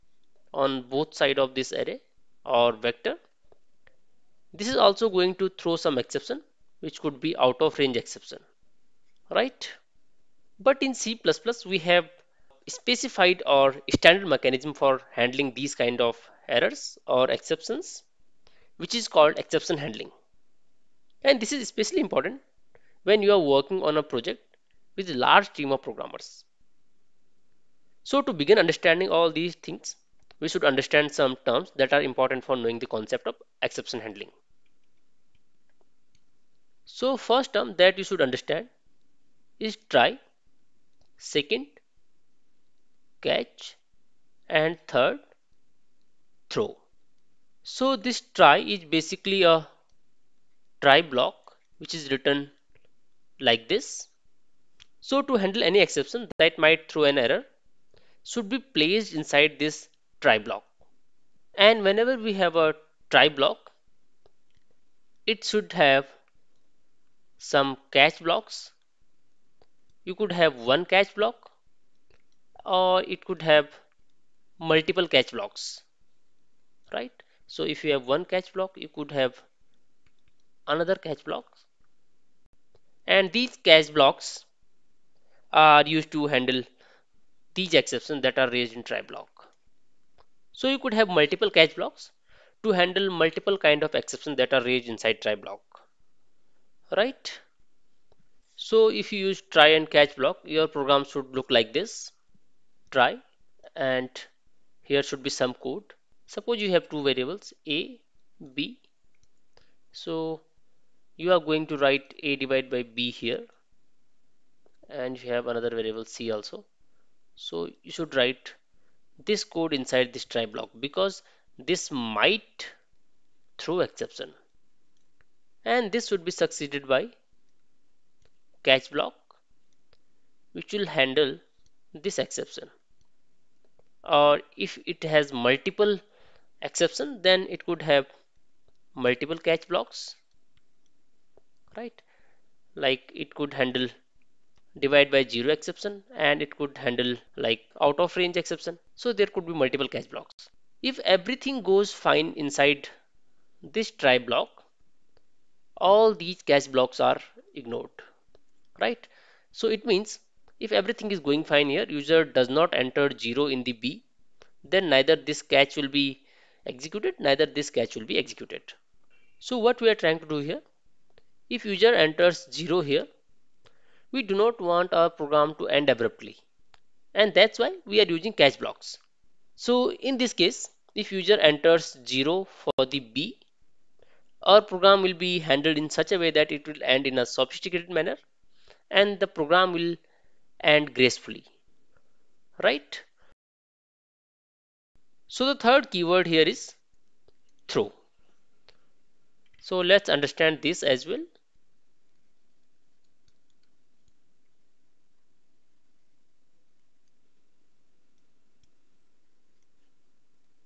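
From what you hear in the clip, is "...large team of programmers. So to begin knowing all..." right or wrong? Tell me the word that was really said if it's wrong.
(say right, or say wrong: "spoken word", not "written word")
wrong: "understanding", not "knowing".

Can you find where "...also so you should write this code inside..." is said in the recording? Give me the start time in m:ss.
1:56.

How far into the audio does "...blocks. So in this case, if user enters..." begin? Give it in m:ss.
2:58.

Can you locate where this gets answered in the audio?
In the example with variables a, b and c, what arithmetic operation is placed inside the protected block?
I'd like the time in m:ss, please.
1:52.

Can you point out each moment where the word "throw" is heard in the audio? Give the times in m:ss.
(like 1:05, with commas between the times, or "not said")
0:05, 0:46, 0:56, 2:03, 3:17.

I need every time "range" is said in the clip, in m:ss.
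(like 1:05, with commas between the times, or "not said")
0:07, 2:28.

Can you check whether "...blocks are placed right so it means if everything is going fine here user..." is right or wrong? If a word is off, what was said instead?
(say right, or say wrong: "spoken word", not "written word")
wrong: "ignored", not "placed".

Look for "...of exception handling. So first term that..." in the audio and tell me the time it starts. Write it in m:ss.
0:33.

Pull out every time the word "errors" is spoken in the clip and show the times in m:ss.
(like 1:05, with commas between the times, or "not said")
0:16, 0:57.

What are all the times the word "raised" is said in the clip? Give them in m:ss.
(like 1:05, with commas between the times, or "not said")
1:28, 1:34.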